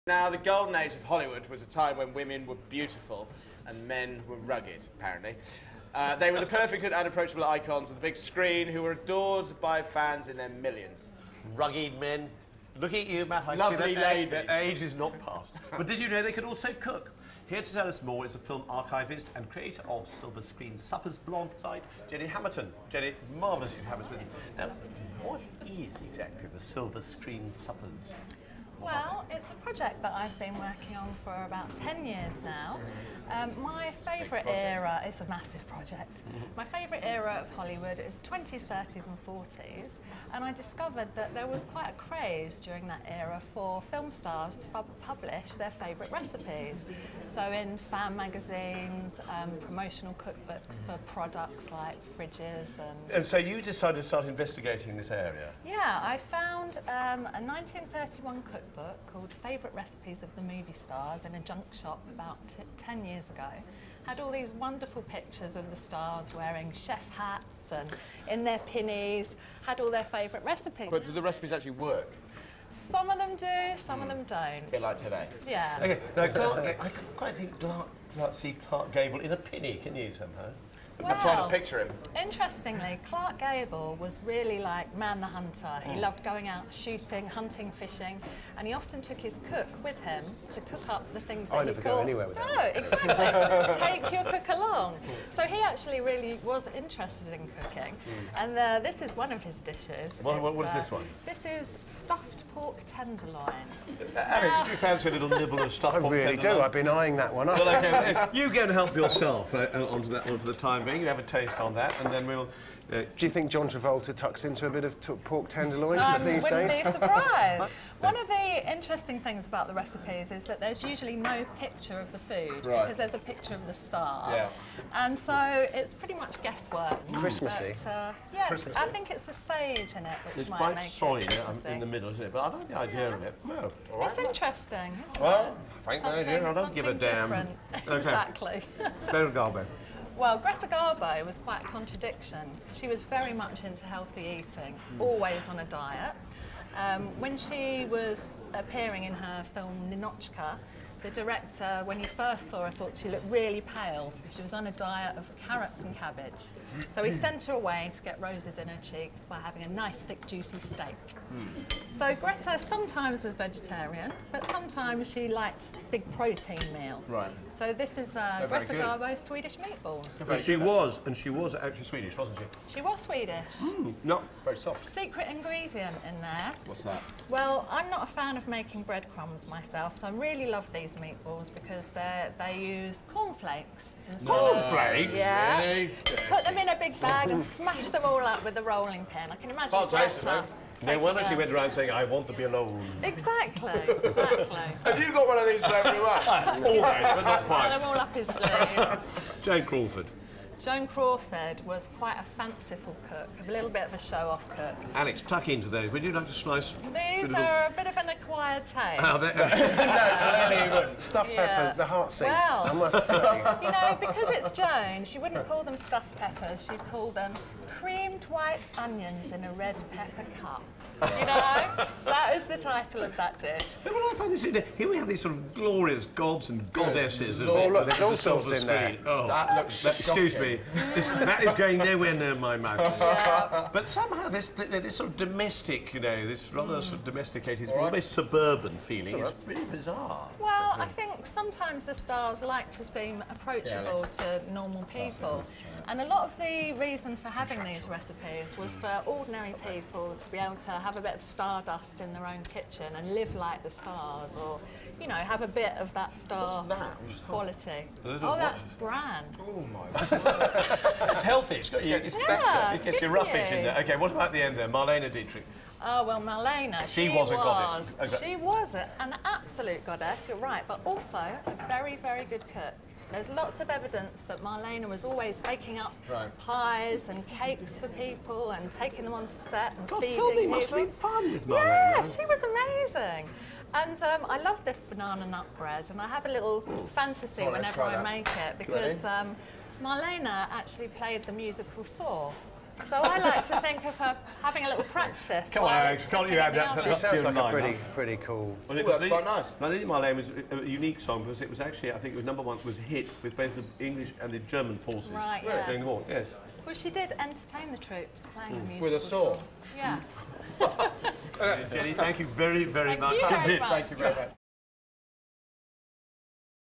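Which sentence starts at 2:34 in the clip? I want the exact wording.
She was on a diet of carrots and cabbage.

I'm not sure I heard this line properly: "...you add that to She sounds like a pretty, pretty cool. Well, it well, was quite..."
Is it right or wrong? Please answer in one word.
right.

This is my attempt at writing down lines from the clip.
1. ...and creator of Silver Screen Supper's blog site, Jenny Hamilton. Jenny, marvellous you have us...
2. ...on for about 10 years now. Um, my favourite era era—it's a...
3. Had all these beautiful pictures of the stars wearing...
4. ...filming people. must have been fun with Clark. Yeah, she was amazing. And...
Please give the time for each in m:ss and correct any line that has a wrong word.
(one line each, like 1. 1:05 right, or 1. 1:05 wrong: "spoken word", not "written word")
1. 0:19 right
2. 0:30 right
3. 1:04 wrong: "wonderful", not "beautiful"
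4. 4:40 wrong: "Marlene", not "Clark".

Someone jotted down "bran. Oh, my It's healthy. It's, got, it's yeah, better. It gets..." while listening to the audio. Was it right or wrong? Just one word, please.
right.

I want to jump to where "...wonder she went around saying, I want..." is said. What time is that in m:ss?
3:10.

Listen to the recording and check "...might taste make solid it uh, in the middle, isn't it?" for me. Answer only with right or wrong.
wrong.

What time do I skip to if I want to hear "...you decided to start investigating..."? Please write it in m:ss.
0:53.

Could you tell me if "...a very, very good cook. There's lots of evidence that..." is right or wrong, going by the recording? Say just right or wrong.
right.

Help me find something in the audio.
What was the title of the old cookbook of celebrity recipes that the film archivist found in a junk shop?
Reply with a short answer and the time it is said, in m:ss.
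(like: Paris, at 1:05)
Favourite Recipes of the Movie Stars, at 0:59.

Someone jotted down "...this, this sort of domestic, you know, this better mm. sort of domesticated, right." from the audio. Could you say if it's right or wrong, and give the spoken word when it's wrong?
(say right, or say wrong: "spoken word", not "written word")
wrong: "rather", not "better".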